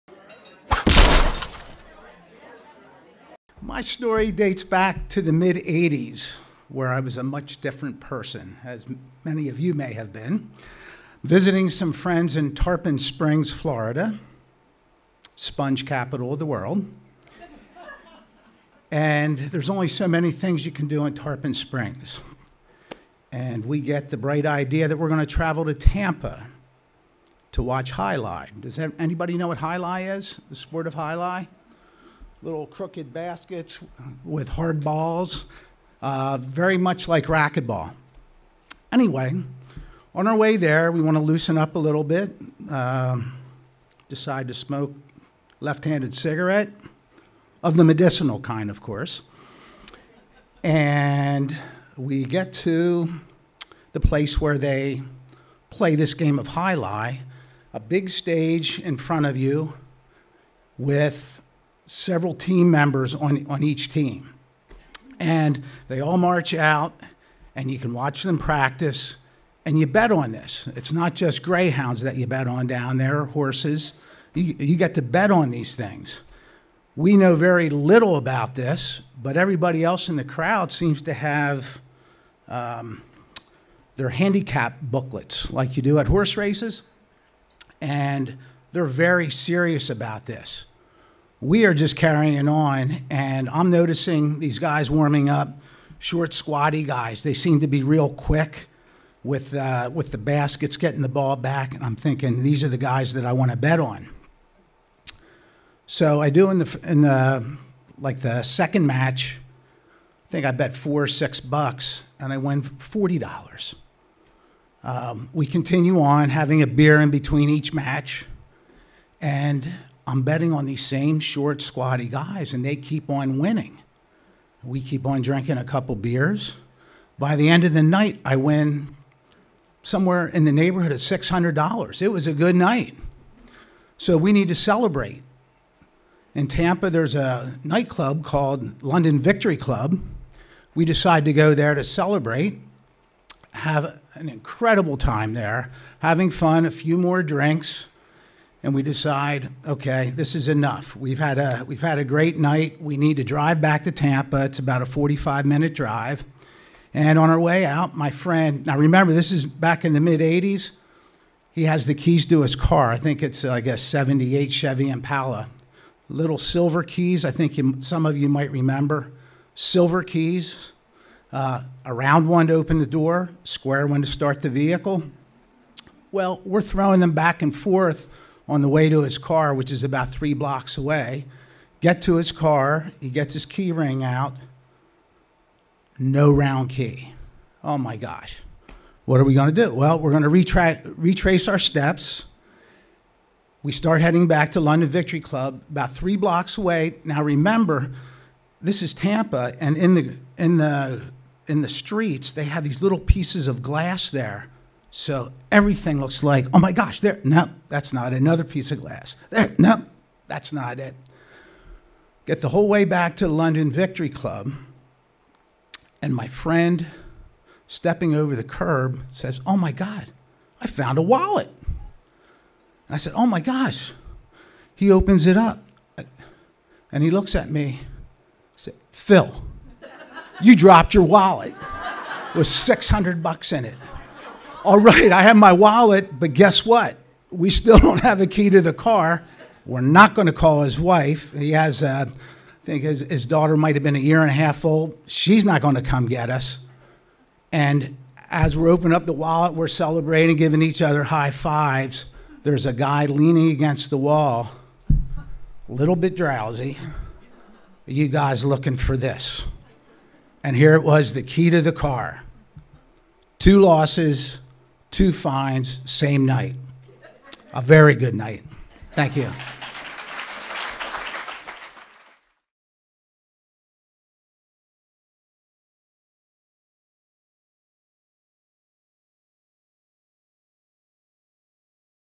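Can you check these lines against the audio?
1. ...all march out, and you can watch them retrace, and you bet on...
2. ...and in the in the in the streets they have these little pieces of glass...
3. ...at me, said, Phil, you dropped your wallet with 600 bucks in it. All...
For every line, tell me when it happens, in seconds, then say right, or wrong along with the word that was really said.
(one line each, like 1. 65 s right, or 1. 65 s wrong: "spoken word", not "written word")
1. 65 s wrong: "practice", not "retrace"
2. 199 s right
3. 227 s right.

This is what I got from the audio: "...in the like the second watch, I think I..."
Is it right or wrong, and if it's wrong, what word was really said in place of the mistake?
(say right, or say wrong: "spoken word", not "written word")
wrong: "match", not "watch".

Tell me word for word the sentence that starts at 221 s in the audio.
And I said, oh my gosh.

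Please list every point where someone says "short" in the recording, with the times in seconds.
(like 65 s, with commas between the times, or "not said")
95 s, 121 s.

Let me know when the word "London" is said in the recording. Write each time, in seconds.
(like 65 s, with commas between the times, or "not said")
138 s, 194 s, 213 s.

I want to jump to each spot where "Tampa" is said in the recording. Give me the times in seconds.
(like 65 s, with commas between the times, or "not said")
25 s, 136 s, 153 s, 198 s.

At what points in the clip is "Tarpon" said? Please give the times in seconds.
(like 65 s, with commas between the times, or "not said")
12 s, 21 s.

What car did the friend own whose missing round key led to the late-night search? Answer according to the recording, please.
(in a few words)
Chevy Impala.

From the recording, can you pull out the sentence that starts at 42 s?
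Um, decide to smoke left-handed cigarette of the medicinal kind, of course.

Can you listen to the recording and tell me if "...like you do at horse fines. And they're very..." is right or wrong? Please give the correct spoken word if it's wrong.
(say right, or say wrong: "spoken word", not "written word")
wrong: "races", not "fines".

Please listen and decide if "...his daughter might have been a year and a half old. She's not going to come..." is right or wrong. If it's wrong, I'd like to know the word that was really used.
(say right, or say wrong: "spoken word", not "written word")
right.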